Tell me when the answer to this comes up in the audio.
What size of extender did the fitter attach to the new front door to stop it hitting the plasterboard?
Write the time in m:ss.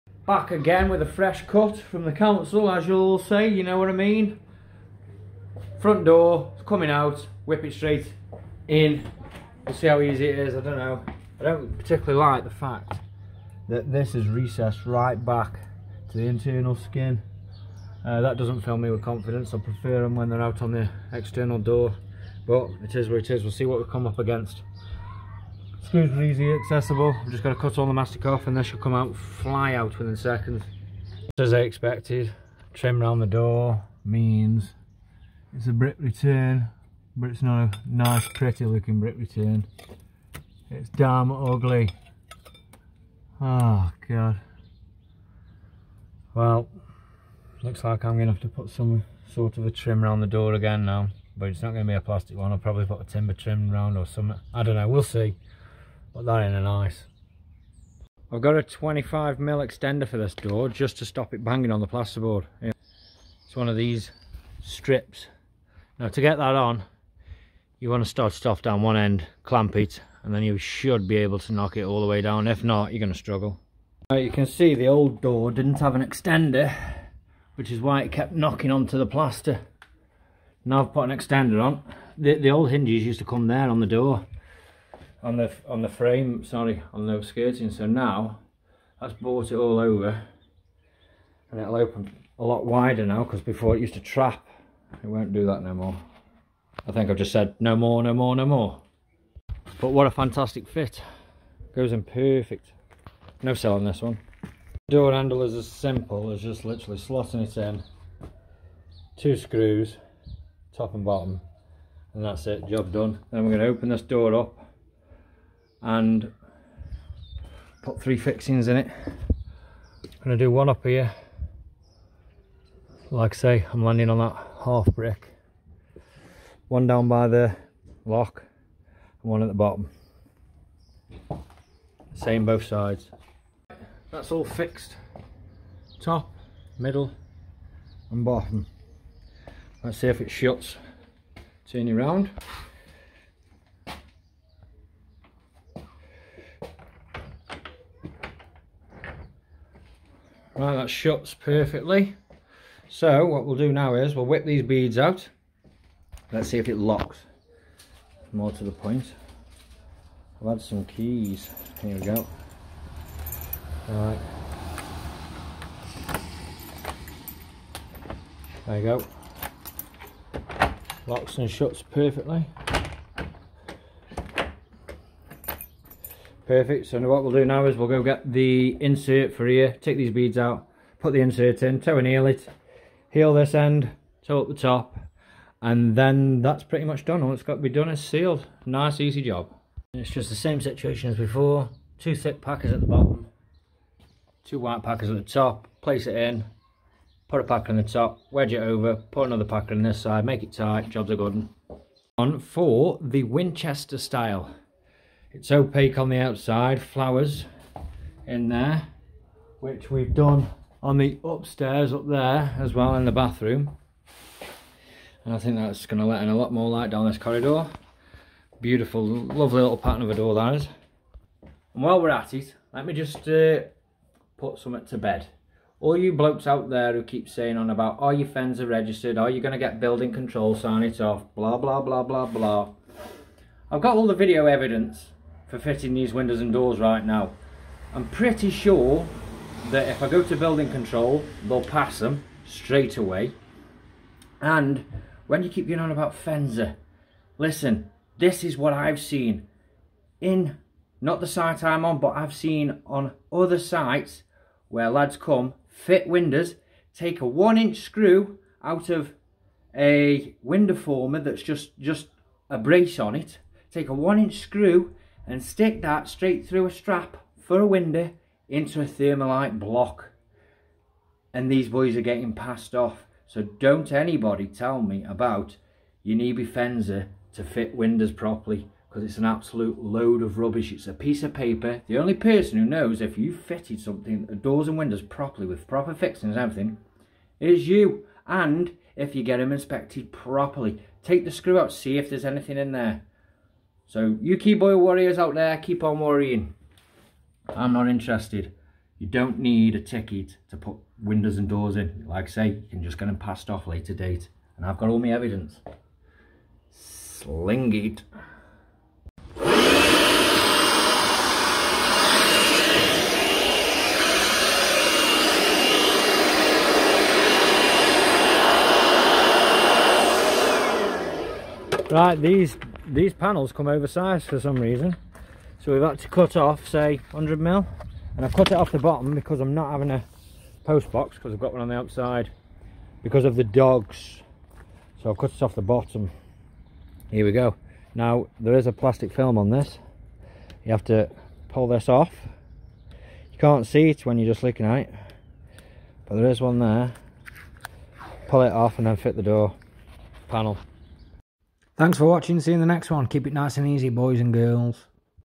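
0:58.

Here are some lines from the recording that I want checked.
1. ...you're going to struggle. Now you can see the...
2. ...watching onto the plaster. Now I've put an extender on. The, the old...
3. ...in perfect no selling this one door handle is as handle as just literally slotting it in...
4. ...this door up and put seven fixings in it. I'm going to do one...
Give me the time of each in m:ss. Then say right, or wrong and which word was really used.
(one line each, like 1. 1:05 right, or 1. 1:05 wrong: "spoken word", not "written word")
1. 1:12 right
2. 1:18 wrong: "knocking", not "watching"
3. 1:41 wrong: "simple", not "handle"
4. 1:53 wrong: "three", not "seven".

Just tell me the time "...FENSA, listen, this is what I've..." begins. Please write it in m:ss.
4:06.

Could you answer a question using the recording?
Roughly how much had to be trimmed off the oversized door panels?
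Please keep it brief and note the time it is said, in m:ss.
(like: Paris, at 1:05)
100 mil, at 5:27.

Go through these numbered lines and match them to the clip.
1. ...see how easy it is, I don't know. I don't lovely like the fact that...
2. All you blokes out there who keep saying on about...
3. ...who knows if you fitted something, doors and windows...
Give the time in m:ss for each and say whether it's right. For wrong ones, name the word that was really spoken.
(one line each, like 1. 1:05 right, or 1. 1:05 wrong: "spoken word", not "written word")
1. 0:09 wrong: "particularly", not "lovely"
2. 3:45 right
3. 4:42 right.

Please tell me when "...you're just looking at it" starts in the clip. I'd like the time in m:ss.
5:44.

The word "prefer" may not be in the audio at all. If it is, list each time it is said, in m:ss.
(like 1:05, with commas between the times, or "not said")
0:19.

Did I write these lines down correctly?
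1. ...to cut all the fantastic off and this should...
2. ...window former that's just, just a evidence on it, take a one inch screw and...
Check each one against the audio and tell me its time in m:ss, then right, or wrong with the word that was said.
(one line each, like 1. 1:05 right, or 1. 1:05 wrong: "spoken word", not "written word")
1. 0:27 wrong: "mastic", not "fantastic"
2. 4:20 wrong: "brace", not "evidence".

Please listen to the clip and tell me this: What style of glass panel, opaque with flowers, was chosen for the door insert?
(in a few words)
Winchester.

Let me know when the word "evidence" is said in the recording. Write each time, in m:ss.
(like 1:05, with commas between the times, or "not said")
3:54, 5:05.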